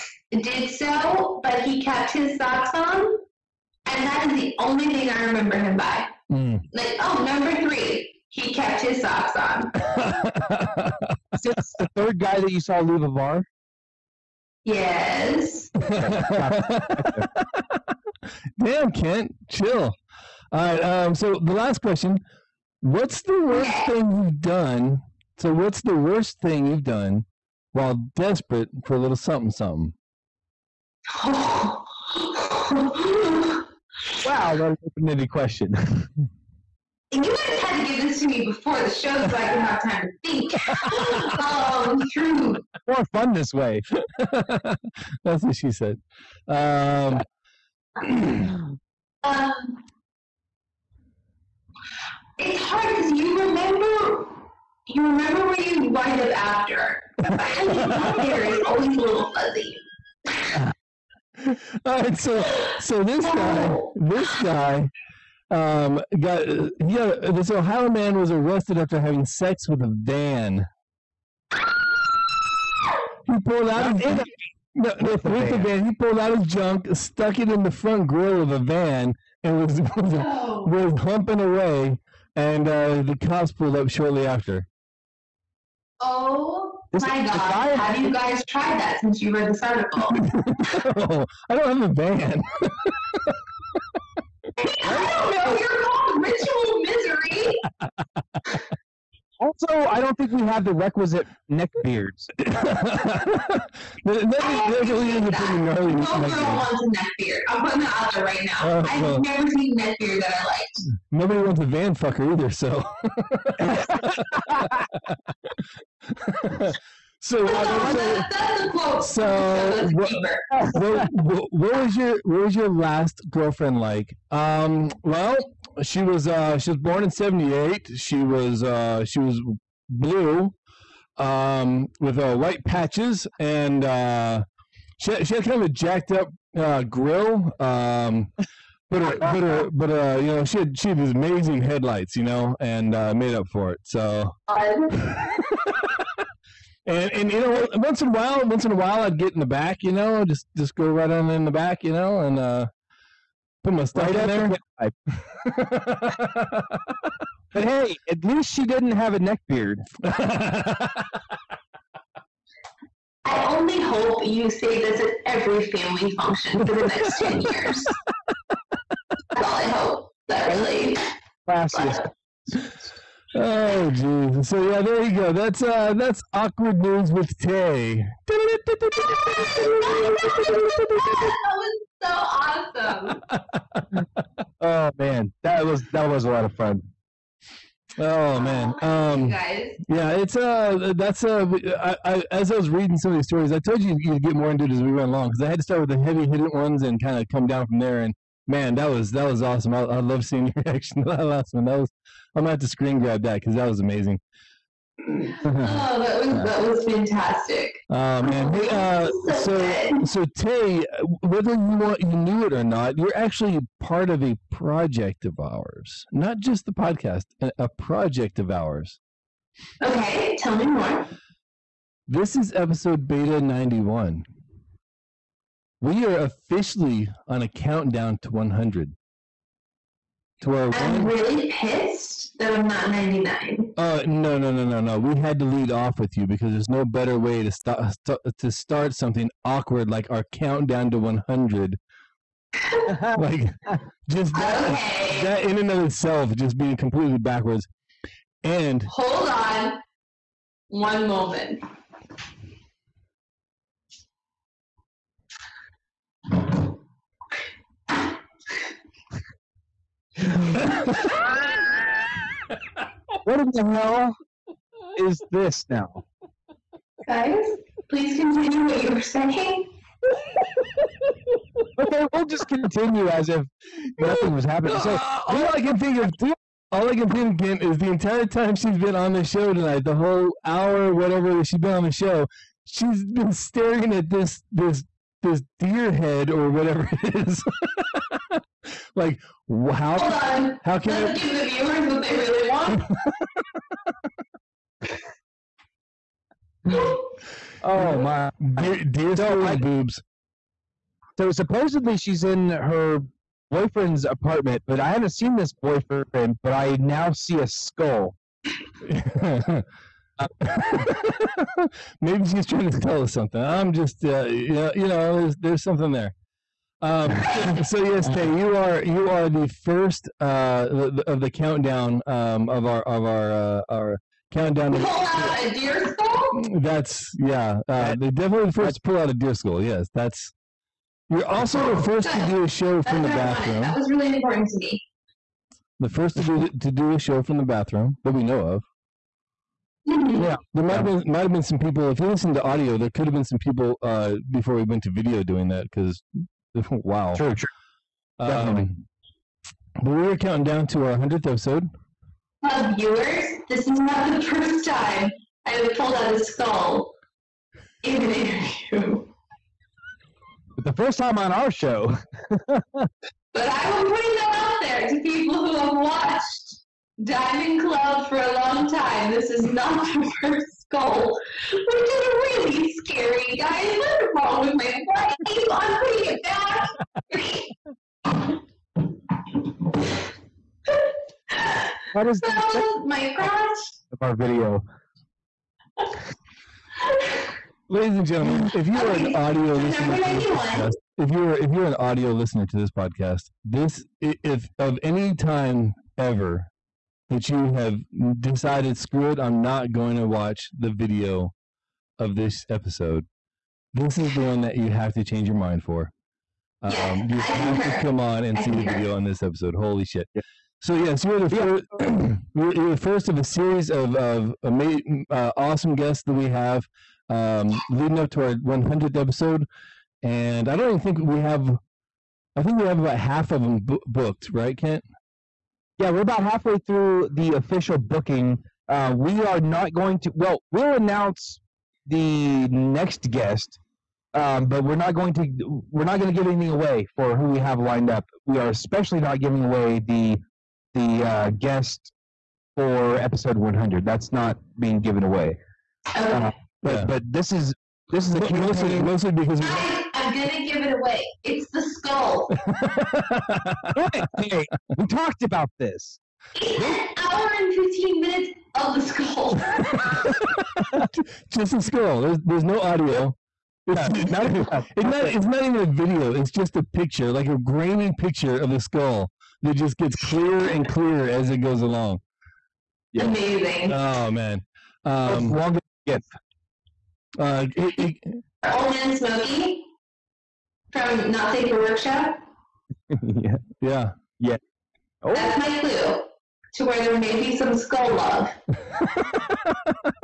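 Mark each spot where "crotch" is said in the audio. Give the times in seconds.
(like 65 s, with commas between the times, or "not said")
383 s.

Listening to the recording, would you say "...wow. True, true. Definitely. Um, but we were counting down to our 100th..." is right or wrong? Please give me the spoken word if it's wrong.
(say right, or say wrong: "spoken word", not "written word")
right.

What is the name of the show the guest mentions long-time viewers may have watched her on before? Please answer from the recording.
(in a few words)
Diamond Club.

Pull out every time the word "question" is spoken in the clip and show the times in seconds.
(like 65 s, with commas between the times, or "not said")
21 s, 35 s.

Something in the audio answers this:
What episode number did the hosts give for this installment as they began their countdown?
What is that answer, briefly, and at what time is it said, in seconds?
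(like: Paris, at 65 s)
Beta 91, at 223 s.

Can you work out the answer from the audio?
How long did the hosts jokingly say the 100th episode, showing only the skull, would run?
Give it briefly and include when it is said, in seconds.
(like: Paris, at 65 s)
1 hour 15 minutes, at 456 s.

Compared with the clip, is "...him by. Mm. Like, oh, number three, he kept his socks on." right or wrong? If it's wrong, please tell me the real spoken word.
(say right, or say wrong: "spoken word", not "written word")
right.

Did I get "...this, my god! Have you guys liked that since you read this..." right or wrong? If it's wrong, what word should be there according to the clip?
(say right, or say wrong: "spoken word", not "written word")
wrong: "tried", not "liked".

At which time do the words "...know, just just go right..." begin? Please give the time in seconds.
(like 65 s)
149 s.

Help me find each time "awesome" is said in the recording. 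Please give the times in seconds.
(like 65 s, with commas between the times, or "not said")
182 s, 199 s, 415 s.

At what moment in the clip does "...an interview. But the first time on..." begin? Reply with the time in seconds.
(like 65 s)
358 s.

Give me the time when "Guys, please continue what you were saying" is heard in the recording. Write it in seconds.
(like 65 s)
267 s.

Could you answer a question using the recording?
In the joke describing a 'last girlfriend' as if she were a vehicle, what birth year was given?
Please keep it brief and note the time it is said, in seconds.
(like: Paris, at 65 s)
1978, at 127 s.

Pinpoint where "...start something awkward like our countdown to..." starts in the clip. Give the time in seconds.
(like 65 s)
238 s.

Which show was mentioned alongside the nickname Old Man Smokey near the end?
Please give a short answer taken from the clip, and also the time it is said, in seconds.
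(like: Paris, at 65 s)
Not Safe for Workshop, at 481 s.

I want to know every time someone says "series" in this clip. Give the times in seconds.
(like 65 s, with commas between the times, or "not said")
413 s.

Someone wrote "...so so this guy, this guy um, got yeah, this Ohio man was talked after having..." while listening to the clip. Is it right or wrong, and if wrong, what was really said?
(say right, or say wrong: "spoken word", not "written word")
wrong: "arrested", not "talked".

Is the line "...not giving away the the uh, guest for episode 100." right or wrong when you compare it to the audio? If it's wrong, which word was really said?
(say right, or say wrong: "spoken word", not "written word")
right.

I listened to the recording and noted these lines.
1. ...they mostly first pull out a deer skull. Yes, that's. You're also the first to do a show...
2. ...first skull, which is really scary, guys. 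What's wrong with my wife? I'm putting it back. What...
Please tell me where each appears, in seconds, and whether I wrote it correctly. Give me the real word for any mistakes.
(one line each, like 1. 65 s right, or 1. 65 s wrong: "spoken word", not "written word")
1. 327 s wrong: "definitely", not "mostly"
2. 370 s right.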